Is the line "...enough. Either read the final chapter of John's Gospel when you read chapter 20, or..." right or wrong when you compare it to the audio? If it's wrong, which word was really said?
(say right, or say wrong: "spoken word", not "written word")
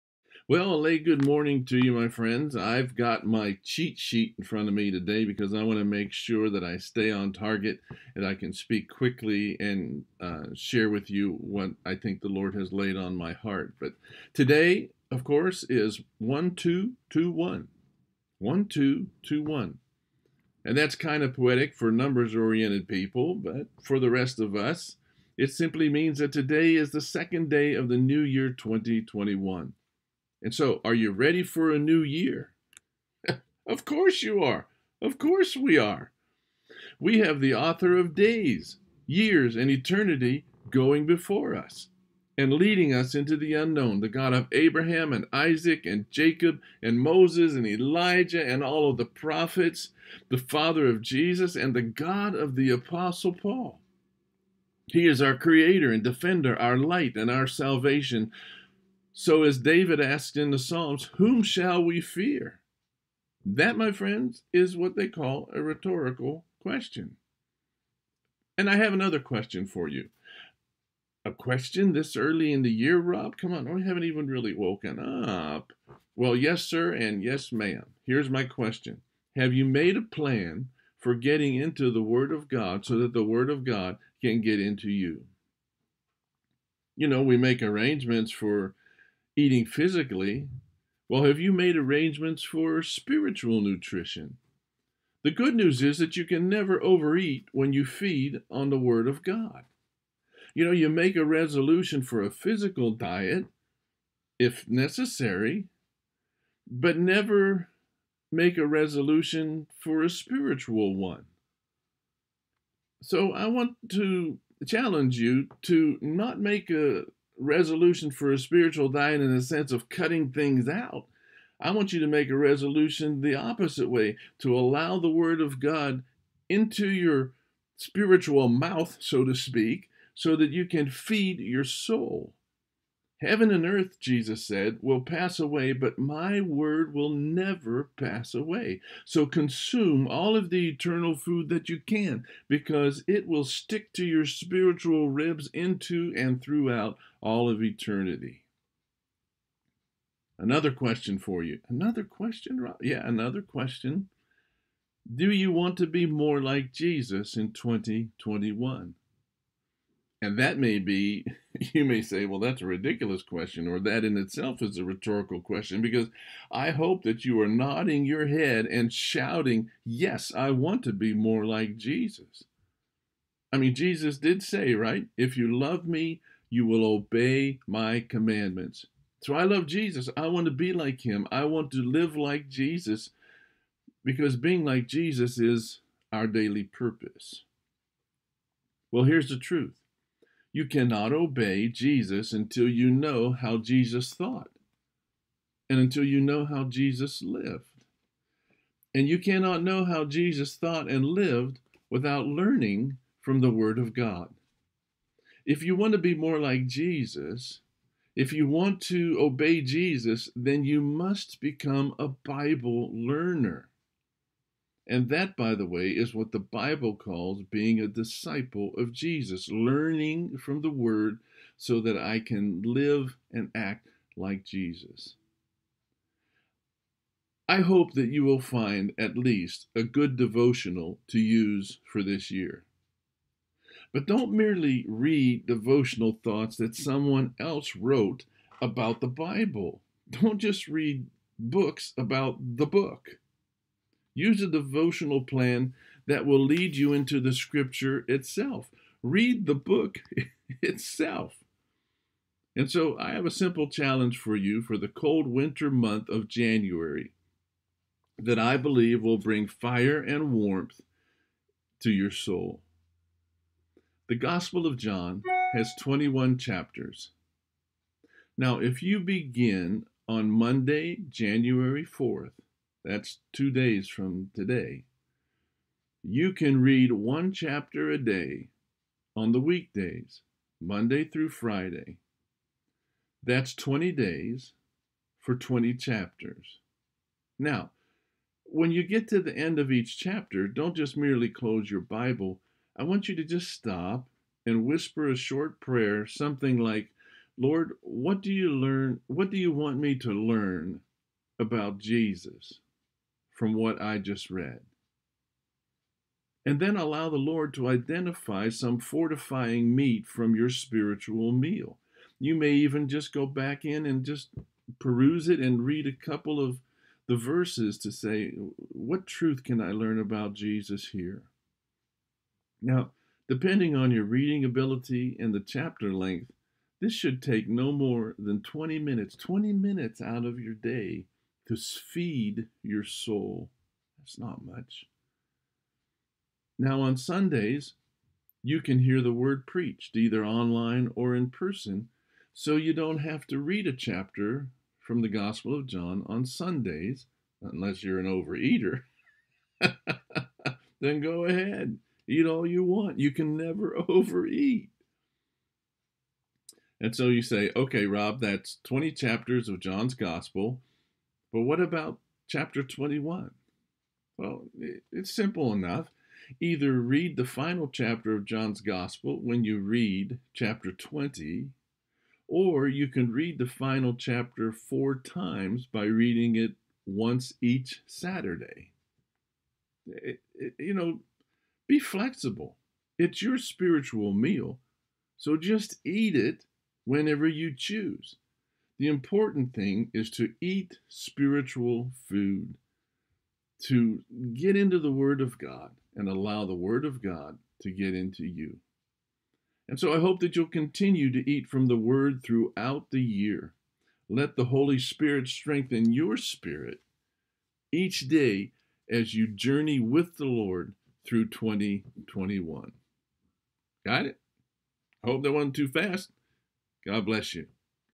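right.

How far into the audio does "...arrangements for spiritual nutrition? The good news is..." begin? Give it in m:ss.
1:31.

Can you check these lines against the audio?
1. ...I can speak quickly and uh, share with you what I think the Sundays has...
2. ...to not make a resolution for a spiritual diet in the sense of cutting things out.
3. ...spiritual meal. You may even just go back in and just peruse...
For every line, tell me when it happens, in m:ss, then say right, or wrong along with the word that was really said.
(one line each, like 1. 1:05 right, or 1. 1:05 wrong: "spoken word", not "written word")
1. 0:08 wrong: "Lord", not "Sundays"
2. 1:55 right
3. 5:10 right.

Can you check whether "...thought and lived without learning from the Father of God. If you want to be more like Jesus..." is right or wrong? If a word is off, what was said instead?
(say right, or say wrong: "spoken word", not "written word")
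wrong: "Word", not "Father".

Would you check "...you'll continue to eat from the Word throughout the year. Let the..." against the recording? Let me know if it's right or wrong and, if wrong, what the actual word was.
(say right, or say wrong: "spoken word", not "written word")
right.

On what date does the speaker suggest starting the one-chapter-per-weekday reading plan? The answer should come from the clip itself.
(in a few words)
Monday, January 4th.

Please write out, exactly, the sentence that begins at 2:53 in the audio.
I mean, Jesus did say, right?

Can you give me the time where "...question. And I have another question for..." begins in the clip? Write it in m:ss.
1:06.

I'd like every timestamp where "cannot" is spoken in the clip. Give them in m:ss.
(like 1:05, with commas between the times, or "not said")
3:10, 3:19.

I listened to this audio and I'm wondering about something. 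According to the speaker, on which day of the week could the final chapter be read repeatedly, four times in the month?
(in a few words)
Saturday.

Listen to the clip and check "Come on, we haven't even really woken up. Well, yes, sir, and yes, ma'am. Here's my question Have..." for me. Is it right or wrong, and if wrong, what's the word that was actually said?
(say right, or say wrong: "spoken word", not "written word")
right.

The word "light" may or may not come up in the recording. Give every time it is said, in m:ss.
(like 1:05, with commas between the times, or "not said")
0:56.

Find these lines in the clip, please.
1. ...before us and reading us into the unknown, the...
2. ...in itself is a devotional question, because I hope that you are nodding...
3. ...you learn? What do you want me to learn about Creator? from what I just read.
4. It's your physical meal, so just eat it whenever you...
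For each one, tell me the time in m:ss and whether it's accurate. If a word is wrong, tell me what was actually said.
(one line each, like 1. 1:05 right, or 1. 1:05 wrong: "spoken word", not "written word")
1. 0:41 wrong: "leading", not "reading"
2. 2:44 wrong: "rhetorical", not "devotional"
3. 4:58 wrong: "Jesus", not "Creator"
4. 6:22 wrong: "spiritual", not "physical".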